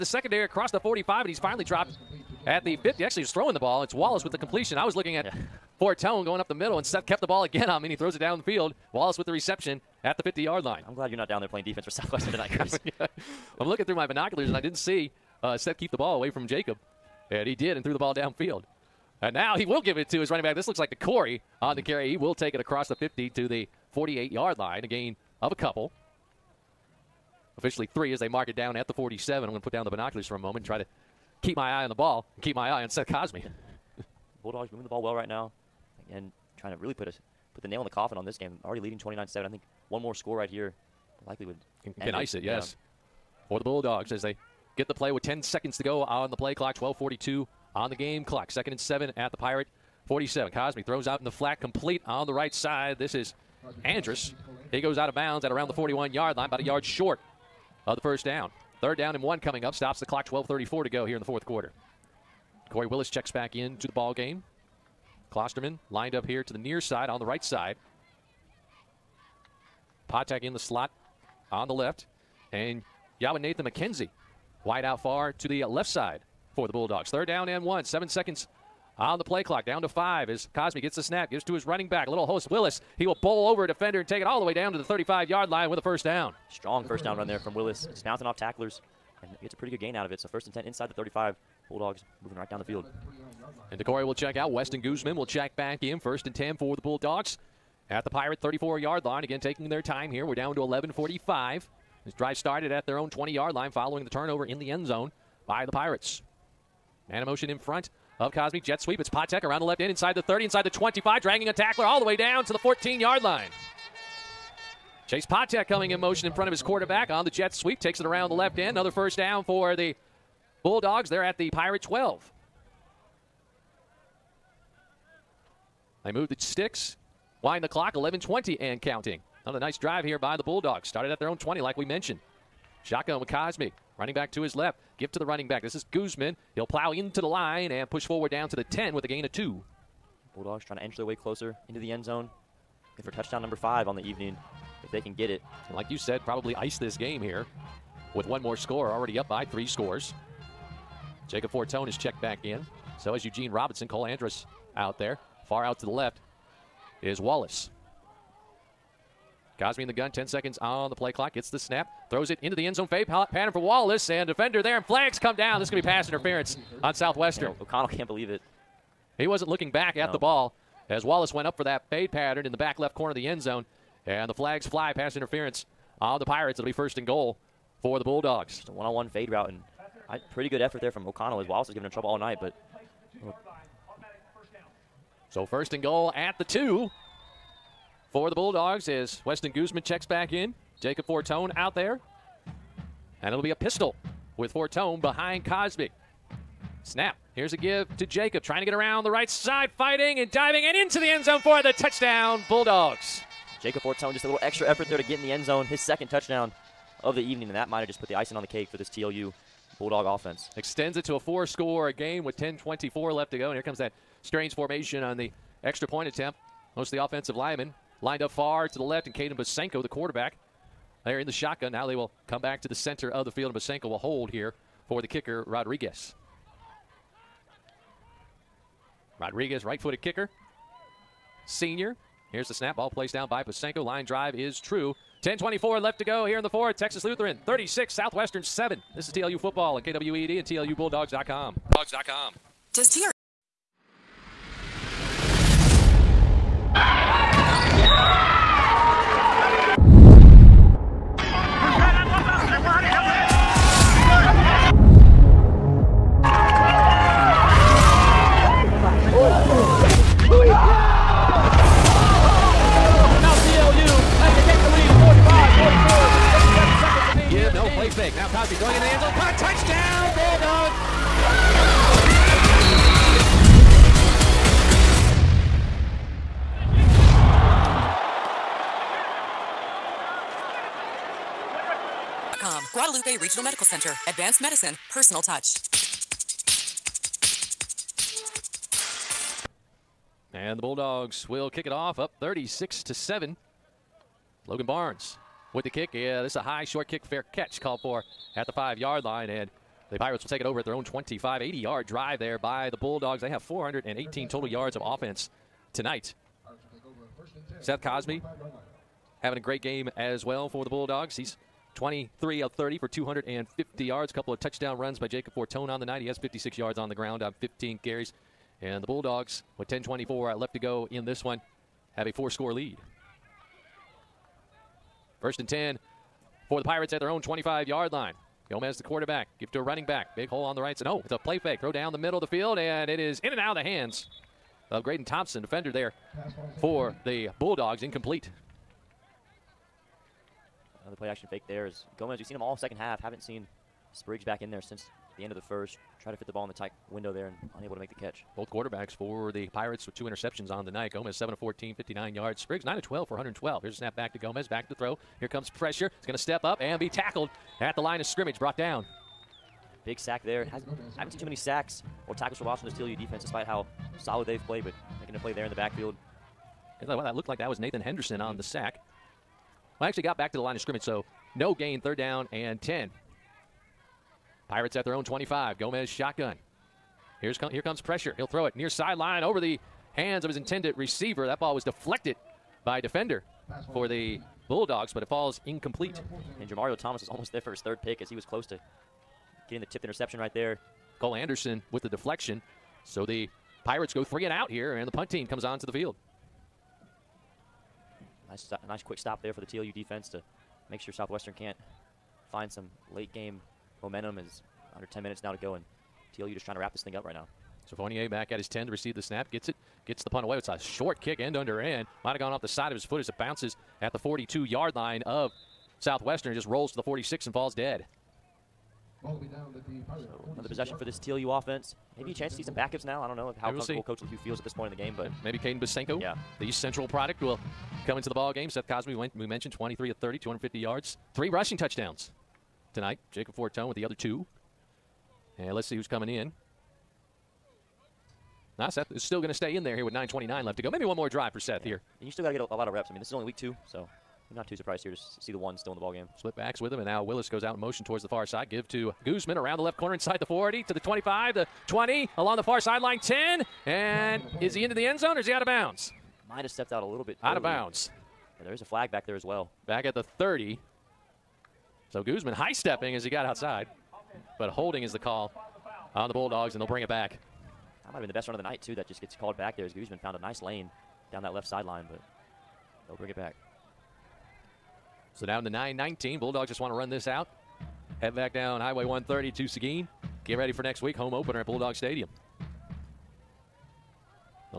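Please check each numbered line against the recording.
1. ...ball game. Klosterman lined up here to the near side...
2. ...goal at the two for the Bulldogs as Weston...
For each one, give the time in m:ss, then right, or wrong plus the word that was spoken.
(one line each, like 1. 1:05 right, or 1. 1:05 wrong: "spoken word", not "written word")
1. 1:03 right
2. 3:05 right.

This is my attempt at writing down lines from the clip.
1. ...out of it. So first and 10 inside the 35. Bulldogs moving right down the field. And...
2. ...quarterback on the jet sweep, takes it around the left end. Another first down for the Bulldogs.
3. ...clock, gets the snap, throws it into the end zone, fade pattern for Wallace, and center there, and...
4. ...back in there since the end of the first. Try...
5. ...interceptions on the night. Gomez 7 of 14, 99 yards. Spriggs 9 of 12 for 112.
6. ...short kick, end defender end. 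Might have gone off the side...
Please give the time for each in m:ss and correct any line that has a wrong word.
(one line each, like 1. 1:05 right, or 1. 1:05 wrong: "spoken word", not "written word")
1. 1:29 right
2. 1:56 right
3. 2:41 wrong: "defender", not "center"
4. 5:44 right
5. 5:50 wrong: "59", not "99"
6. 6:50 wrong: "under", not "defender".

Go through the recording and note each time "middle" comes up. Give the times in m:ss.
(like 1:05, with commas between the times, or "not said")
0:06, 5:31.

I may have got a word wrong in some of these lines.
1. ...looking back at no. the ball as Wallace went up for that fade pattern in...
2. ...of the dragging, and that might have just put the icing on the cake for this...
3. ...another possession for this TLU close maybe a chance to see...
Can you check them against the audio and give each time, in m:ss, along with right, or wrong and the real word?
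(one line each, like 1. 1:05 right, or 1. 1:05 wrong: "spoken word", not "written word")
1. 2:49 right
2. 3:27 wrong: "evening", not "dragging"
3. 7:00 wrong: "offense", not "close".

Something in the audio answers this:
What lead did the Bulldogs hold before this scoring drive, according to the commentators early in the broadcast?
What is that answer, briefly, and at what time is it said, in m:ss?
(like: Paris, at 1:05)
29-7, at 0:38.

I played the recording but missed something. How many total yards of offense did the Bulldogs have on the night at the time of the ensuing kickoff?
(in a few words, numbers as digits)
418.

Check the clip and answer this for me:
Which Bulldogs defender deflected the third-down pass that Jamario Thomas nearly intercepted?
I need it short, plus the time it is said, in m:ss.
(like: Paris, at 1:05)
Cole Anderson, at 6:30.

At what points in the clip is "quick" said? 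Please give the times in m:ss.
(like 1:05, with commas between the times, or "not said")
6:38.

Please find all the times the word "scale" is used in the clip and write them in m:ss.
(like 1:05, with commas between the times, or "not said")
not said.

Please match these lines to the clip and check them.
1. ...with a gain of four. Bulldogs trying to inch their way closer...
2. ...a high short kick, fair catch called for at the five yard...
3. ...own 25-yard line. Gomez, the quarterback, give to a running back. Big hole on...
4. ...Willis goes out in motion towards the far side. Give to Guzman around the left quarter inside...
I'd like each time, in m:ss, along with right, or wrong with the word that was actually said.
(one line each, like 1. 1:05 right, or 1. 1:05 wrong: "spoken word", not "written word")
1. 2:18 wrong: "two", not "four"
2. 4:56 right
3. 5:27 right
4. 7:27 wrong: "corner", not "quarter".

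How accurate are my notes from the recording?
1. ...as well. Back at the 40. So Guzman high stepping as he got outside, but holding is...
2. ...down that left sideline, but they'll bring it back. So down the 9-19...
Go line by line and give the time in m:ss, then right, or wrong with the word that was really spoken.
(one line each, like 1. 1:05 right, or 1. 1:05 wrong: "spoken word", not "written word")
1. 7:39 wrong: "30", not "40"
2. 7:51 right.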